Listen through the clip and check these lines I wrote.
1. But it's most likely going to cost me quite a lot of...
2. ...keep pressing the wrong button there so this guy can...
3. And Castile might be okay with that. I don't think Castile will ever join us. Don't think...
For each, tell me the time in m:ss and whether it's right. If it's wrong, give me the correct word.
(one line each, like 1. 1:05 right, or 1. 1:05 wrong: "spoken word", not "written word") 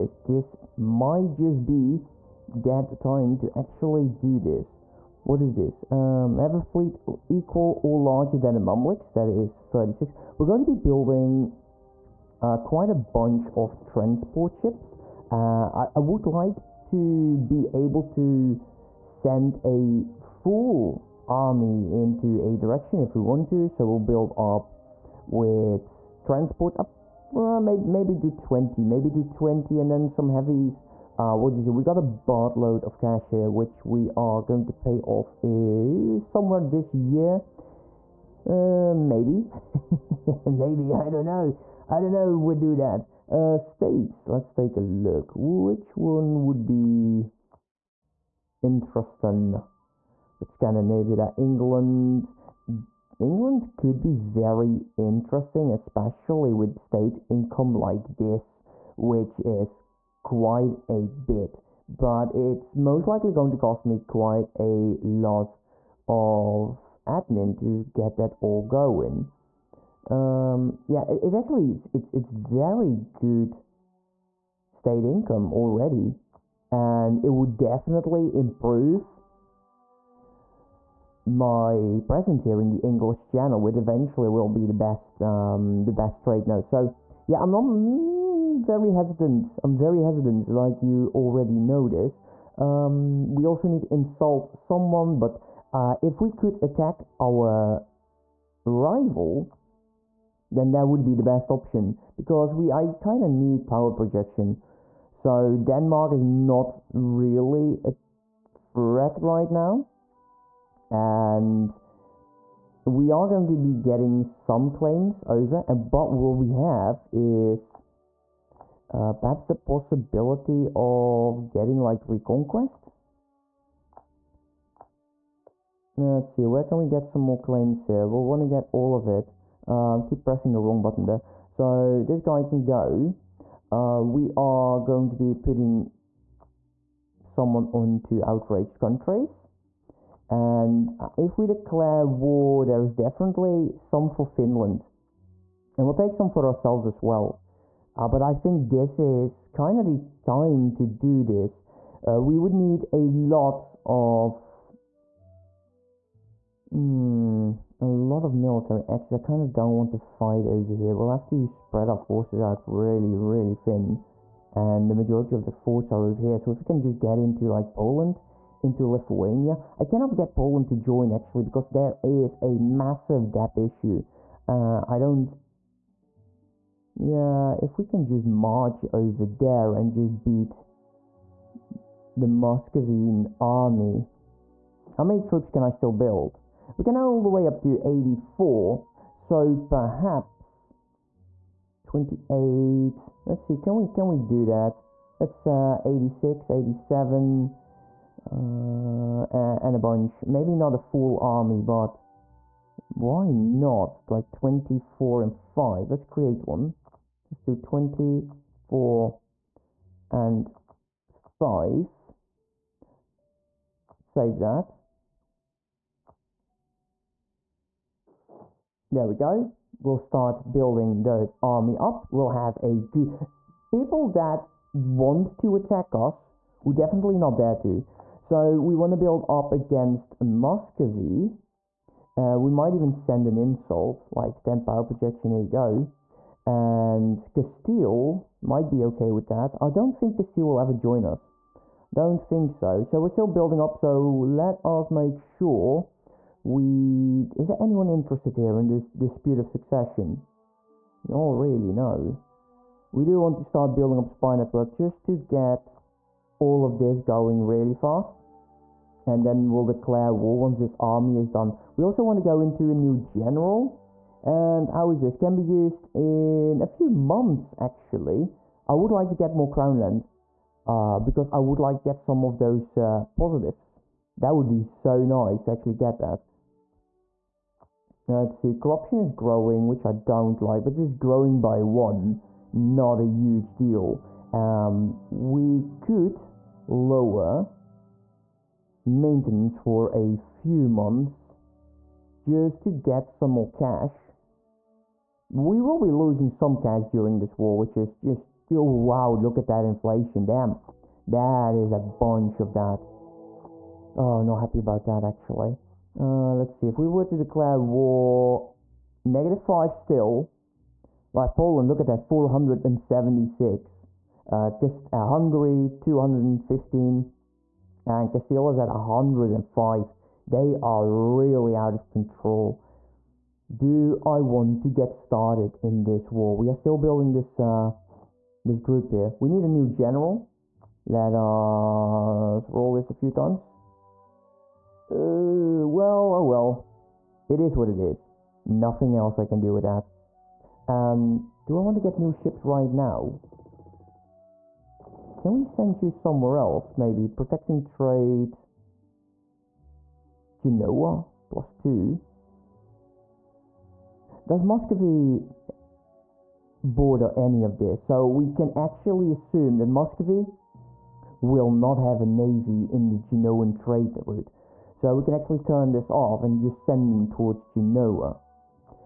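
1. 1:01 right
2. 2:10 right
3. 3:56 right.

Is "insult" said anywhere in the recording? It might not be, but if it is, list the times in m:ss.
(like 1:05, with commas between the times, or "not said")
1:33, 3:53.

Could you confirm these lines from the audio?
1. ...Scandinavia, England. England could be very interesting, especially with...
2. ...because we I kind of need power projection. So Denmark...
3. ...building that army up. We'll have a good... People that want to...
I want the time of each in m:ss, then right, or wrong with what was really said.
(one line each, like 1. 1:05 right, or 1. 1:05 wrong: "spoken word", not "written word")
1. 0:50 right
2. 1:42 right
3. 3:40 right.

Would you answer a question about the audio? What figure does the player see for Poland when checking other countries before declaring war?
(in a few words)
476.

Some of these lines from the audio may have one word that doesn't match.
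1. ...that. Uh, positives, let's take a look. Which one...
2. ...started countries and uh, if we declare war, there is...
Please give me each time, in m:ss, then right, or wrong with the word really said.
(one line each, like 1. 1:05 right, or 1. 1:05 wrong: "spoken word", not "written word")
1. 0:42 wrong: "states", not "positives"
2. 2:18 wrong: "outraged", not "started".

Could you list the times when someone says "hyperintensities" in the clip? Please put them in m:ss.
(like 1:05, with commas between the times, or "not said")
not said.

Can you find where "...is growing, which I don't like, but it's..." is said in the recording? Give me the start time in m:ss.
4:38.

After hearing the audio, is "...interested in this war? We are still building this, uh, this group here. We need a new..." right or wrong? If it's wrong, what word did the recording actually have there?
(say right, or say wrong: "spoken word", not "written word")
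wrong: "started", not "interested".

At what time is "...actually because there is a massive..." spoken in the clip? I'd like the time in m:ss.
2:51.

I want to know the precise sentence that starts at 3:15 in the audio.
That's uh, 86, 87, uh, and a bunch.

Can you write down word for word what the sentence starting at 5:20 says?
They are really out of control.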